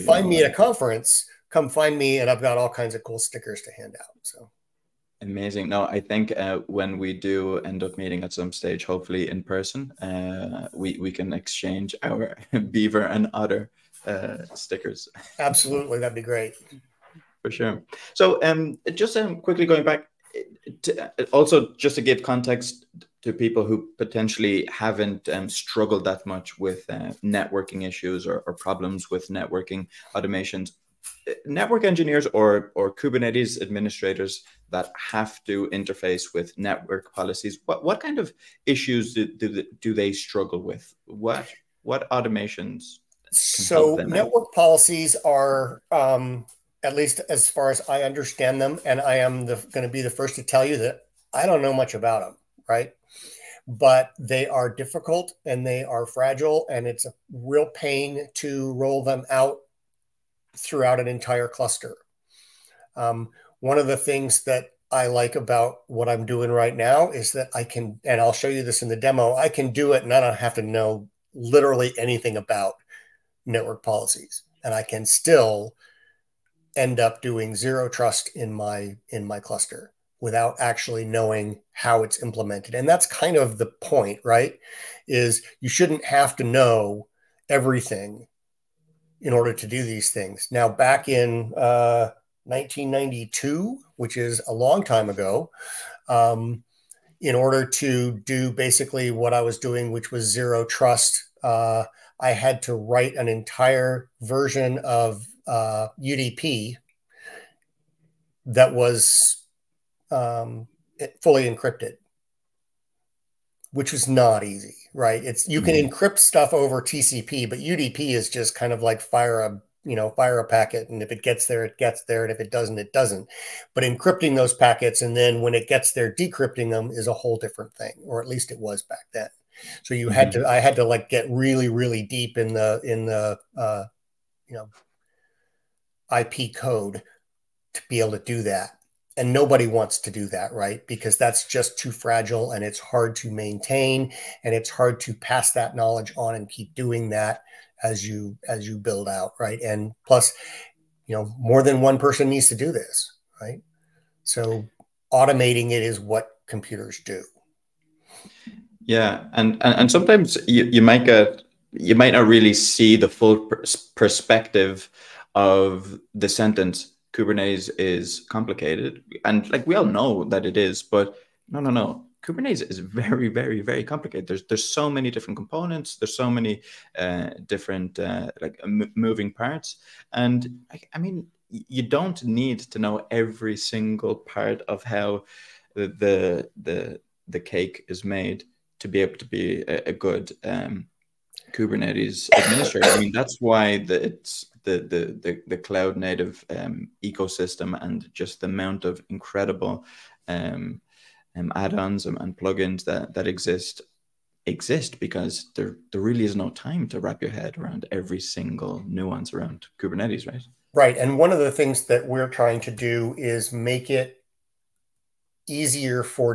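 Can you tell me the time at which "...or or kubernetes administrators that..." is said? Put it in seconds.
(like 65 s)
32 s.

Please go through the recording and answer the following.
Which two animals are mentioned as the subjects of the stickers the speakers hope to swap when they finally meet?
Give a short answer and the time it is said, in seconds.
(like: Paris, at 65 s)
beaver and otter, at 12 s.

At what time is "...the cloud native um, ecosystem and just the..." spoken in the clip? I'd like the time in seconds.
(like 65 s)
195 s.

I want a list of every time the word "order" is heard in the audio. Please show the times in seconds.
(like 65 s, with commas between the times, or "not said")
89 s, 97 s.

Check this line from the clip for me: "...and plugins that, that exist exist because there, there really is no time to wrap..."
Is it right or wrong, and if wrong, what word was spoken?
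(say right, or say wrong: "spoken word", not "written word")
right.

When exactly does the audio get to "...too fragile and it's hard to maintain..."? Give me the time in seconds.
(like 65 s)
141 s.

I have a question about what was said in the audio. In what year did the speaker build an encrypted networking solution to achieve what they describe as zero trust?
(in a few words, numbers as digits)
1992.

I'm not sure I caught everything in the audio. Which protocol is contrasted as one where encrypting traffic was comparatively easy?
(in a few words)
TCP.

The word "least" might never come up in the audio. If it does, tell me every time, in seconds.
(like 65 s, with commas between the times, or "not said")
46 s, 128 s.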